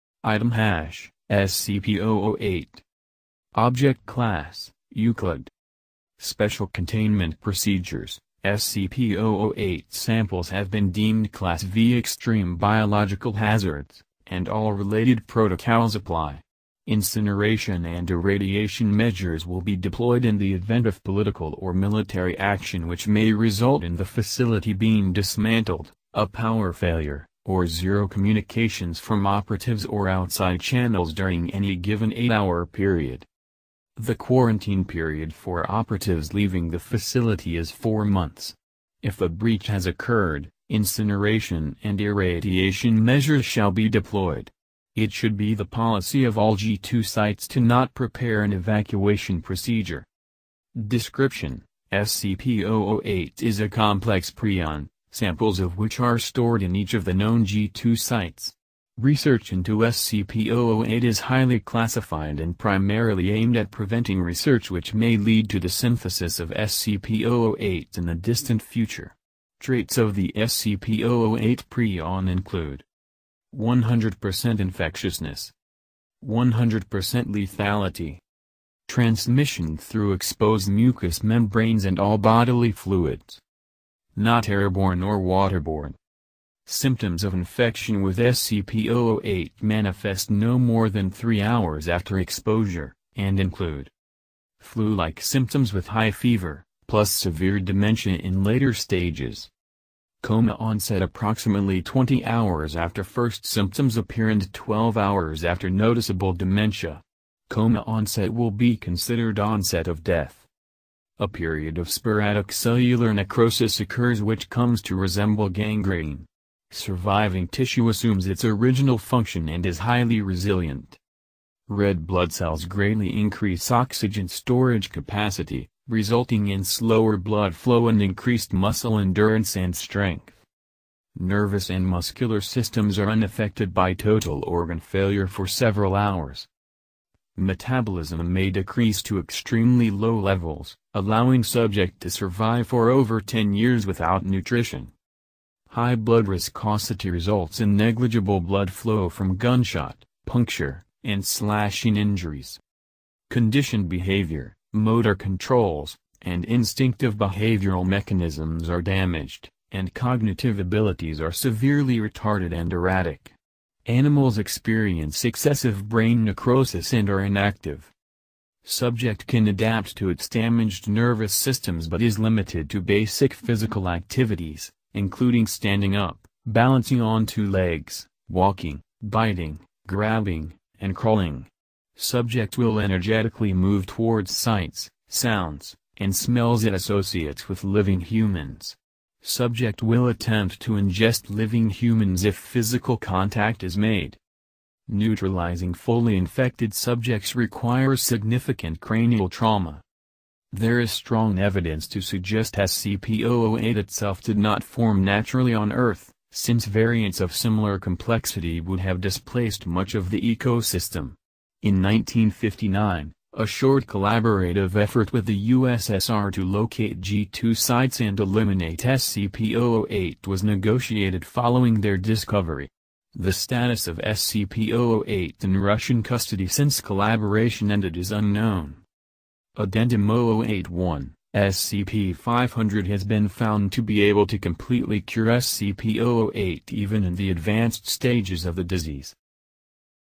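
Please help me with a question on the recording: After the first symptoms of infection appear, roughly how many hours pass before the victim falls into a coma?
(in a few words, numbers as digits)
20 hours.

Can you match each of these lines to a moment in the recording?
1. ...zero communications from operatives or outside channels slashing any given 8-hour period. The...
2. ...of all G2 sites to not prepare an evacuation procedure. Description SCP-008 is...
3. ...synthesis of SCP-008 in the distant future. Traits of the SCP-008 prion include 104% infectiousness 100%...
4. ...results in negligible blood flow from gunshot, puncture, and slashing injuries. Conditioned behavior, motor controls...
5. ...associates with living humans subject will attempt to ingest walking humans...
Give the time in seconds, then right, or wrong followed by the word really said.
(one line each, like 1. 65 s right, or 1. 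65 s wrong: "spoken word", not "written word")
1. 27 s wrong: "during", not "slashing"
2. 46 s right
3. 65 s wrong: "100", not "104"
4. 147 s right
5. 186 s wrong: "living", not "walking".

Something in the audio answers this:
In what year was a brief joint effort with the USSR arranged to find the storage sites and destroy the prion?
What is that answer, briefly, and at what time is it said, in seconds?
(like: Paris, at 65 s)
1959, at 211 s.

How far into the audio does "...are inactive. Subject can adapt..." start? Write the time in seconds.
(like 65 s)
167 s.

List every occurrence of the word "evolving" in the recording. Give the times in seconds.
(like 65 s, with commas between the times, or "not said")
not said.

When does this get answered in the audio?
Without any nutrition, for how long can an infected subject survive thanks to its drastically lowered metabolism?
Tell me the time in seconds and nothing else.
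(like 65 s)
142 s.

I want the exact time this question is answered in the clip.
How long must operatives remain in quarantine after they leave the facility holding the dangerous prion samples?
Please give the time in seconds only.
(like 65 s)
37 s.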